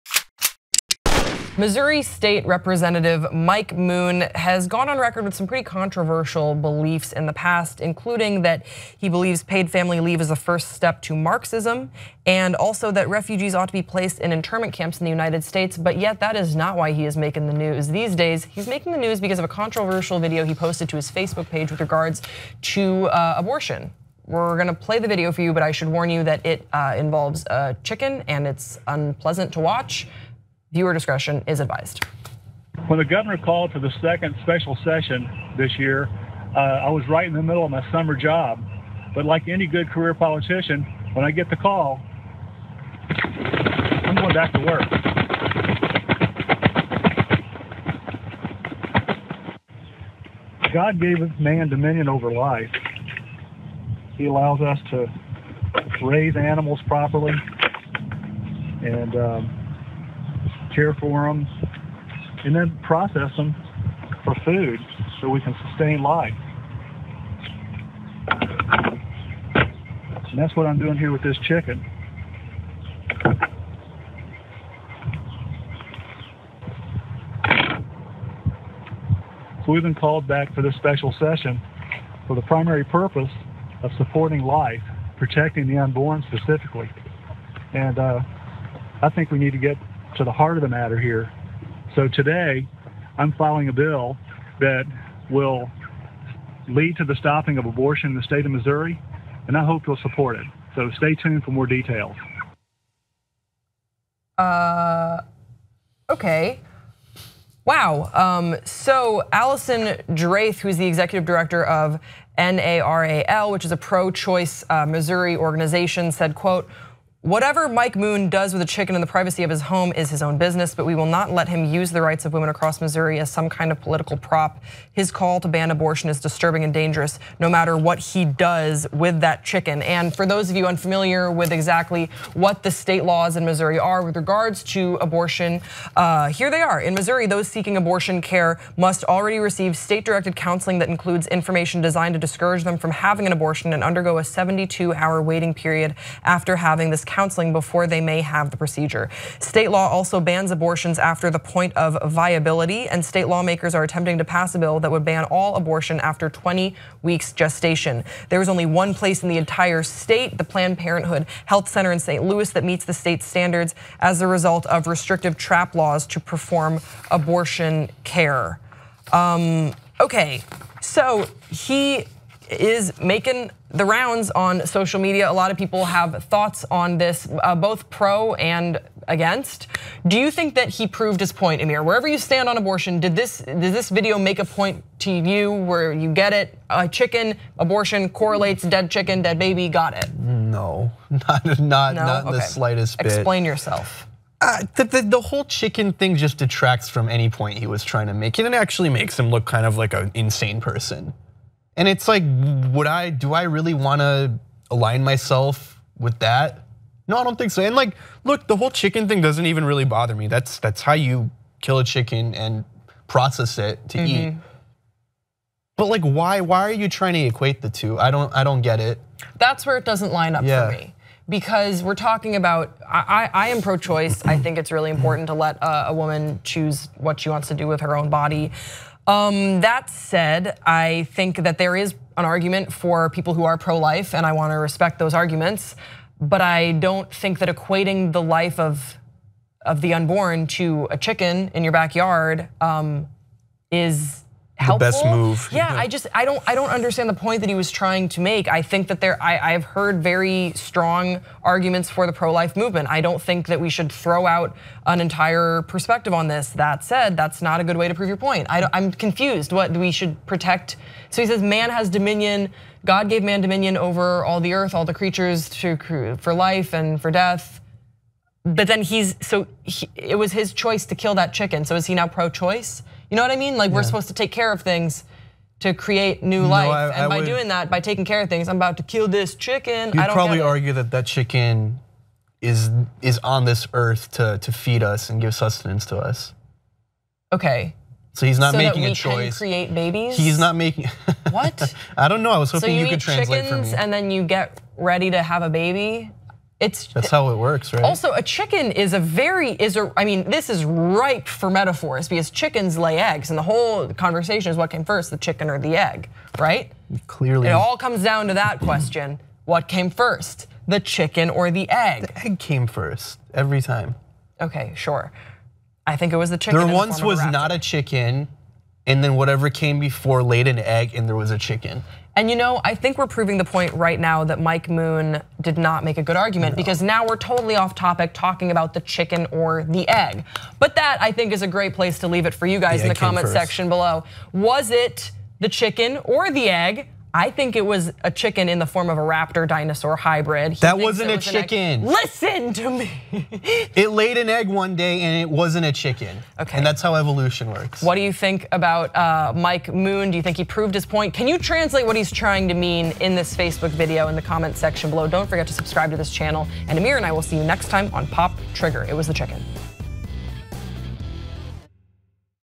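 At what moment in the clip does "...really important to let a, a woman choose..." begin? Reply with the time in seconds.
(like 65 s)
224 s.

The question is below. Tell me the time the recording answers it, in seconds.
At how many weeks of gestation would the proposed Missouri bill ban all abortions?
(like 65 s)
156 s.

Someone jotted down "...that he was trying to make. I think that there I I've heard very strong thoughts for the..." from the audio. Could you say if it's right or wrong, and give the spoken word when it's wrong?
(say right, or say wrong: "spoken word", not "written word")
wrong: "arguments", not "thoughts".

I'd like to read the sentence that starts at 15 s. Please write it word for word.
But yet, that is not why he is making the news these days.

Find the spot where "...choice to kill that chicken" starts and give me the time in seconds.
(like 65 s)
270 s.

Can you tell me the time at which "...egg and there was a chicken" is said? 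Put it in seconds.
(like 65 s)
320 s.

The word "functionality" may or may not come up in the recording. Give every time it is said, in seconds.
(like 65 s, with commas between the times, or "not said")
not said.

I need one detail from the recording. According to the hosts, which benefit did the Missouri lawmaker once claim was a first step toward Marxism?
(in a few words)
paid family leave.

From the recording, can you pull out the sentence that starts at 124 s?
His call to ban abortion is disturbing and dangerous, no matter what he does with that chicken.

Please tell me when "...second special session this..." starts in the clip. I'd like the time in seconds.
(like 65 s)
34 s.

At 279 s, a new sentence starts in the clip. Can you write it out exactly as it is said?
You'd probably argue that that chicken is is on this earth to to feed us and give sustenance to us.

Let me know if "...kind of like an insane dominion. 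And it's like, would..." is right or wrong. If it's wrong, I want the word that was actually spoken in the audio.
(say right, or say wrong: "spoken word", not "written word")
wrong: "person", not "dominion".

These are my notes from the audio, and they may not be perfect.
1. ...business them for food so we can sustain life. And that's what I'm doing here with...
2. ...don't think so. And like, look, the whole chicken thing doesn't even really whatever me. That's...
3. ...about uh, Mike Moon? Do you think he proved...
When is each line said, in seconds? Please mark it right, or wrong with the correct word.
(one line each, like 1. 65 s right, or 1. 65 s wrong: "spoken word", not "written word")
1. 62 s wrong: "process", not "business"
2. 207 s wrong: "bother", not "whatever"
3. 348 s right.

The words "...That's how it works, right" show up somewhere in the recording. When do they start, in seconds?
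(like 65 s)
296 s.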